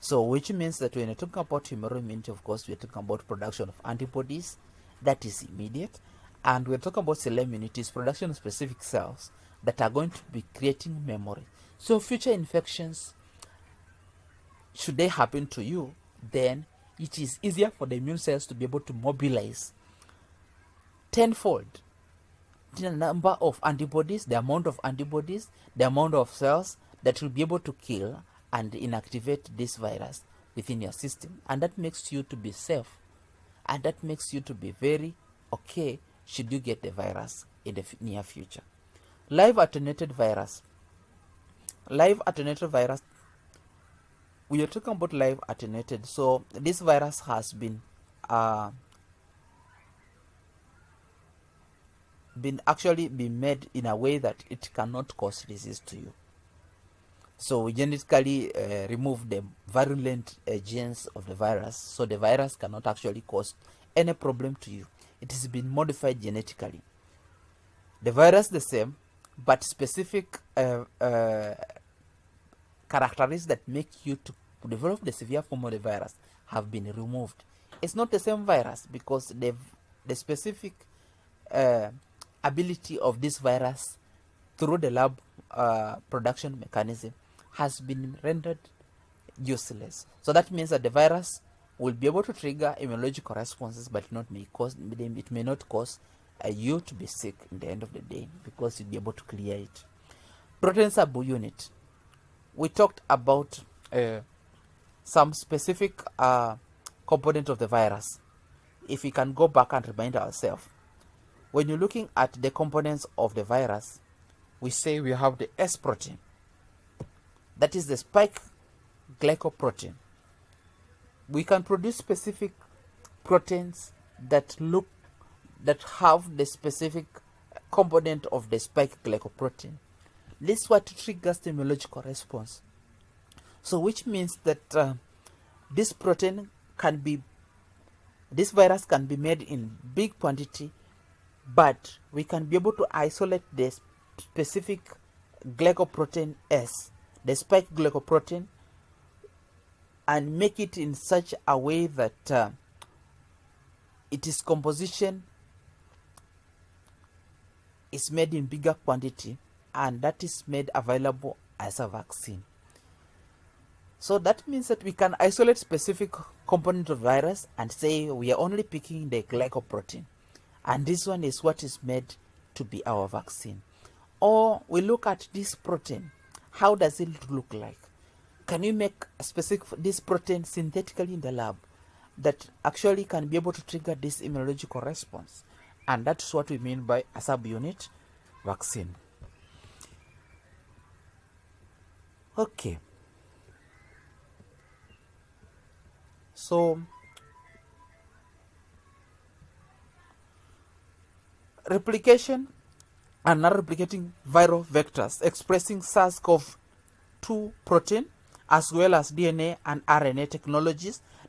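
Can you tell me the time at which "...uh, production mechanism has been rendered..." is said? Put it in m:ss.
1:25.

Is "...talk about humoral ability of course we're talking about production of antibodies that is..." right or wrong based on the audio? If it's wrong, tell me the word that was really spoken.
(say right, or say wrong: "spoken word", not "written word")
wrong: "immunity", not "ability".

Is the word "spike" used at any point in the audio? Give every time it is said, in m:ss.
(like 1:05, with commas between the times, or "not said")
1:57, 2:08, 2:27.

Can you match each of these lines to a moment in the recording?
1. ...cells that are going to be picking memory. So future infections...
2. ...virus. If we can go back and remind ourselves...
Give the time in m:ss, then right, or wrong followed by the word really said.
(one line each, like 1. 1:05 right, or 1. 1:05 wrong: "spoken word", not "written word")
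1. 0:08 wrong: "creating", not "picking"
2. 1:47 right.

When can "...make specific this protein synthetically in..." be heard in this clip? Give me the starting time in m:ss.
2:58.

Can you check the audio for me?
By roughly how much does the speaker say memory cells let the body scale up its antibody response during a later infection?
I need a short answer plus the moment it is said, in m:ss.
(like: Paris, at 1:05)
tenfold, at 0:21.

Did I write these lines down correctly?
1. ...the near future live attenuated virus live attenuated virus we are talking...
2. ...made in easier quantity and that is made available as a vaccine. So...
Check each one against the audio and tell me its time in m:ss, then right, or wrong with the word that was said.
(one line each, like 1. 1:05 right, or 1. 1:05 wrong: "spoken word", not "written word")
1. 0:37 right
2. 2:38 wrong: "bigger", not "easier".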